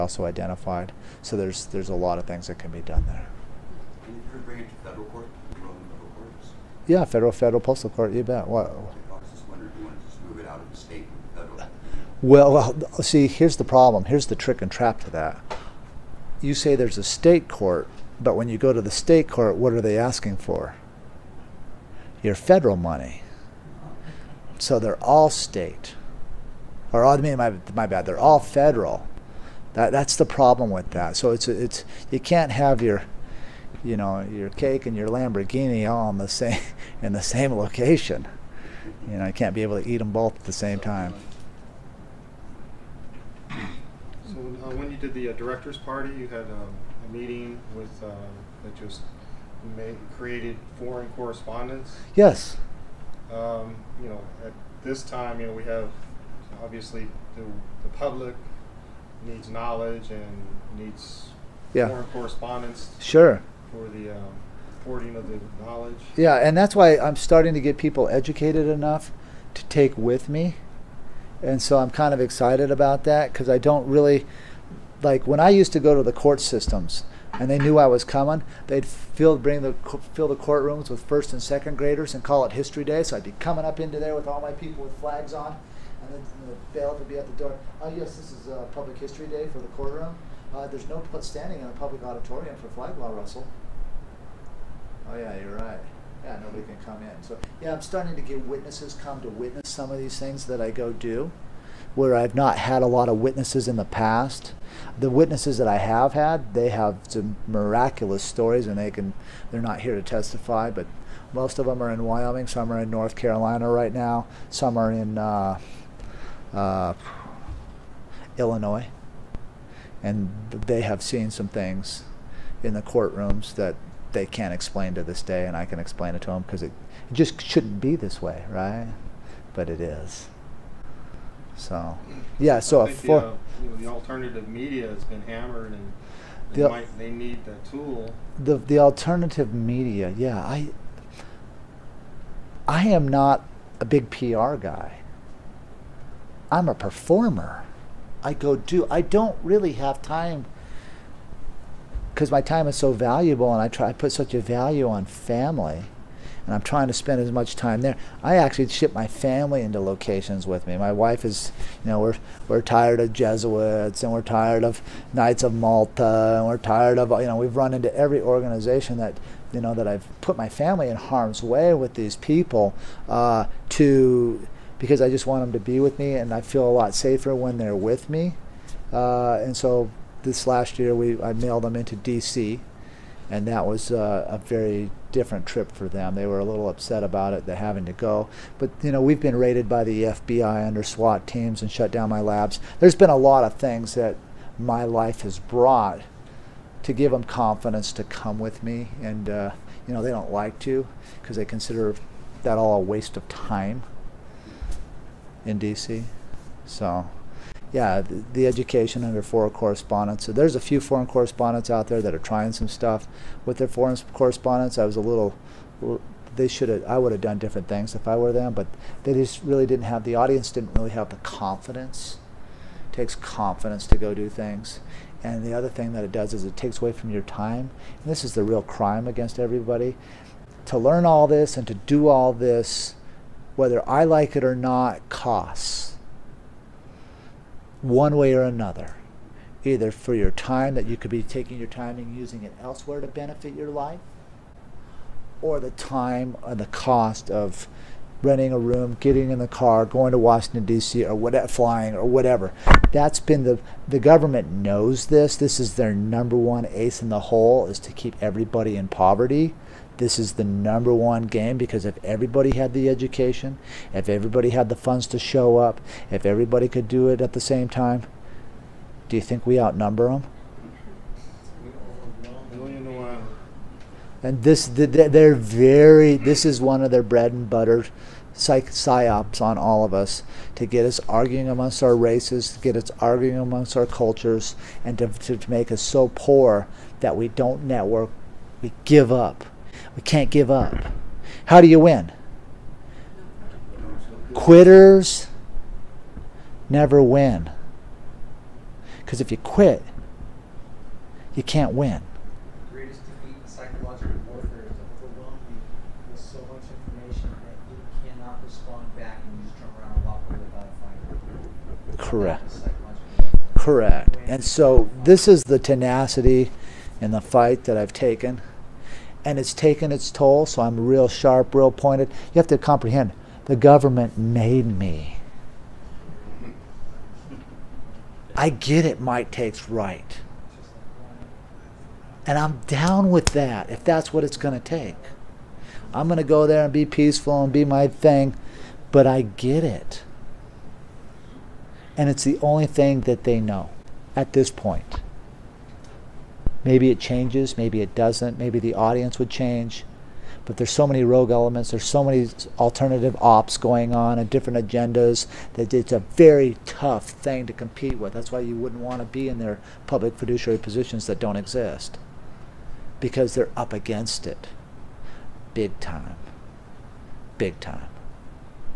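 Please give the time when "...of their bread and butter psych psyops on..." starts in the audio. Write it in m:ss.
4:36.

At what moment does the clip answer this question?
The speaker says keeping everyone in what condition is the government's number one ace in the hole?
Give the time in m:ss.
4:18.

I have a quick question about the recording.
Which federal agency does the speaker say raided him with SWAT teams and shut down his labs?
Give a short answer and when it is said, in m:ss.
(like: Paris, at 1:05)
FBI, at 3:10.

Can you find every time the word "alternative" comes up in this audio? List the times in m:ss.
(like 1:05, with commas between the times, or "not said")
2:13, 2:18, 5:52.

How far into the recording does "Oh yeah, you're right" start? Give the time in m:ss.
1:35.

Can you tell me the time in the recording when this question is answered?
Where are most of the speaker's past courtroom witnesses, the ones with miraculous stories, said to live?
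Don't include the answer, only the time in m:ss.
1:52.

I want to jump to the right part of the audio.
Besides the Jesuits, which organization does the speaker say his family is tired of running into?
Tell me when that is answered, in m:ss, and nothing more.
2:45.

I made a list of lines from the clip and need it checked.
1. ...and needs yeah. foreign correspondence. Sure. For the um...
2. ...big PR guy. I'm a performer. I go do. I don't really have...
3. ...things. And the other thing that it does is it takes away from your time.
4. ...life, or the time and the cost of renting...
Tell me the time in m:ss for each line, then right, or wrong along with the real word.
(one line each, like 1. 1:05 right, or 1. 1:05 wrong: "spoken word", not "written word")
1. 1:00 right
2. 2:23 right
3. 3:44 right
4. 4:03 right.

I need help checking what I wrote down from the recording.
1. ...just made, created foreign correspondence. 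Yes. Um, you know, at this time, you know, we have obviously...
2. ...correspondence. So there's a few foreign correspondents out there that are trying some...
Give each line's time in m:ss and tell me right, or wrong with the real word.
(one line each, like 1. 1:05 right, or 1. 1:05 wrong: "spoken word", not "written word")
1. 0:48 right
2. 3:29 right.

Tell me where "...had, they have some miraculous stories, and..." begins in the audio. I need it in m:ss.
1:46.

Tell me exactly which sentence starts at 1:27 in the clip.
Oh yes, this is uh, Public History Day for the courtroom.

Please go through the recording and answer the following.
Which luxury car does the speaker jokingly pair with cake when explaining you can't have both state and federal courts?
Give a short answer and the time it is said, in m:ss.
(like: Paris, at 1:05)
Lamborghini, at 0:35.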